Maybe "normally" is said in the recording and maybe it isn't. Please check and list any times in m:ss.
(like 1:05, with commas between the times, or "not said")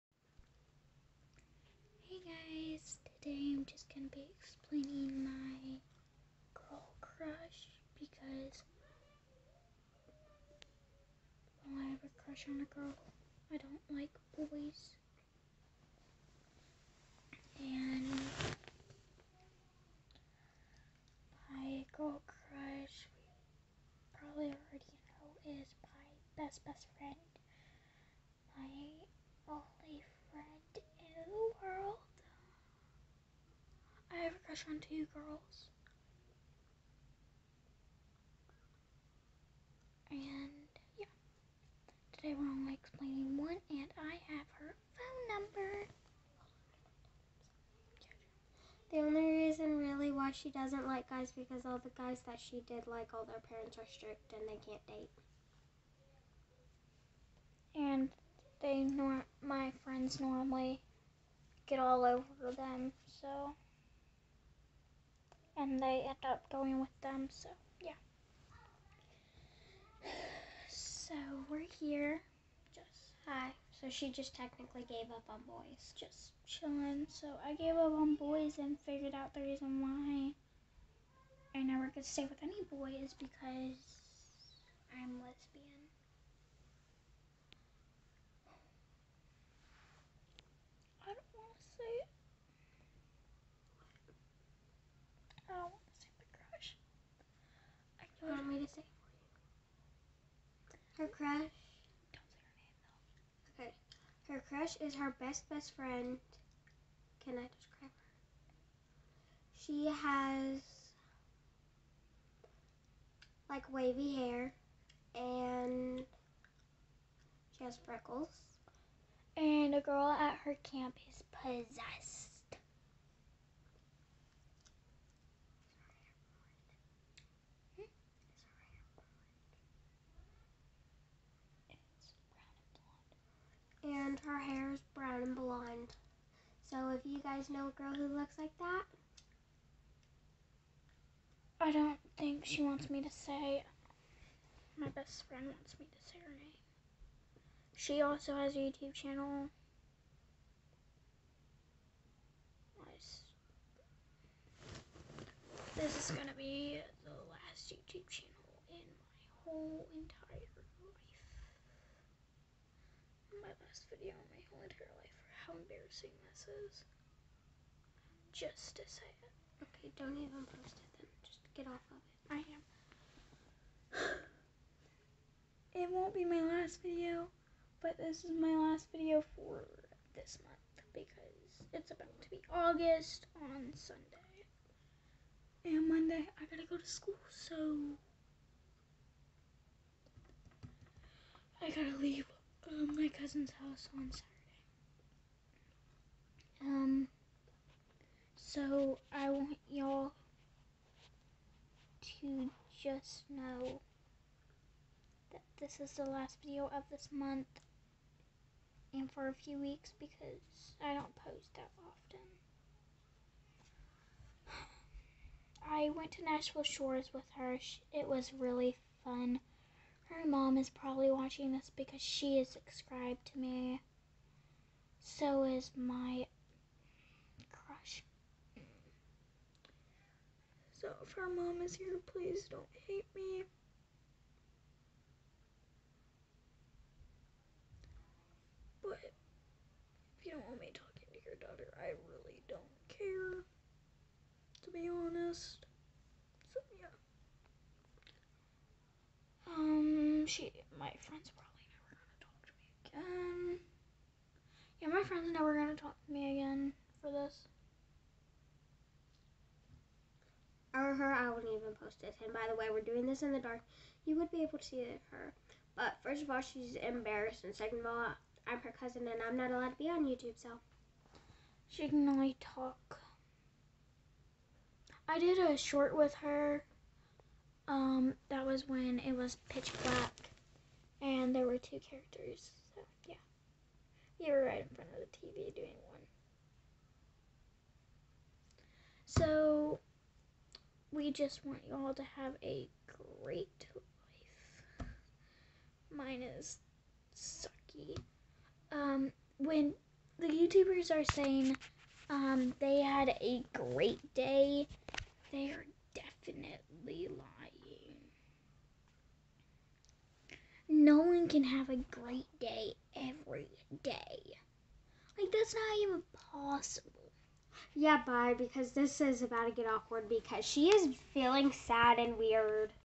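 1:00.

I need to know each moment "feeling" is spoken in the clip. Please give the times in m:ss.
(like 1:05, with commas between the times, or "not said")
5:21.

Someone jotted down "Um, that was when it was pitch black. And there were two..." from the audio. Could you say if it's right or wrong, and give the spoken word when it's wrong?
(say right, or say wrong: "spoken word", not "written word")
right.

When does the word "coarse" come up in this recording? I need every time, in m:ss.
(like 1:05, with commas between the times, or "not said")
not said.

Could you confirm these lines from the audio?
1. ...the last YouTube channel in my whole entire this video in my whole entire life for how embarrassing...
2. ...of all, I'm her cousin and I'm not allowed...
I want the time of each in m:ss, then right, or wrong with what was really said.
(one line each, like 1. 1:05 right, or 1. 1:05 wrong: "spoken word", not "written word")
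1. 2:37 right
2. 4:27 right.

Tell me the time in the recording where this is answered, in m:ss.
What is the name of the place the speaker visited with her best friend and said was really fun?
3:36.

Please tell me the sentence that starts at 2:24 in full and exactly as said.
My best friend wants me to say her name.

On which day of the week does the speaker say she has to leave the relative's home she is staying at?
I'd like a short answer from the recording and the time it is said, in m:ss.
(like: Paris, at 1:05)
Saturday, at 3:14.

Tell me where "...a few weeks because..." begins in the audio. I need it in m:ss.
3:29.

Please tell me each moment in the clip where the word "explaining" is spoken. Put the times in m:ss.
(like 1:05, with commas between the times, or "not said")
0:04, 0:42.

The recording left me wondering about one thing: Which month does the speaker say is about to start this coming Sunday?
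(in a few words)
August.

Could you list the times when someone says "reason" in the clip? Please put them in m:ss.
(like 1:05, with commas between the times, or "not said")
0:49, 1:19.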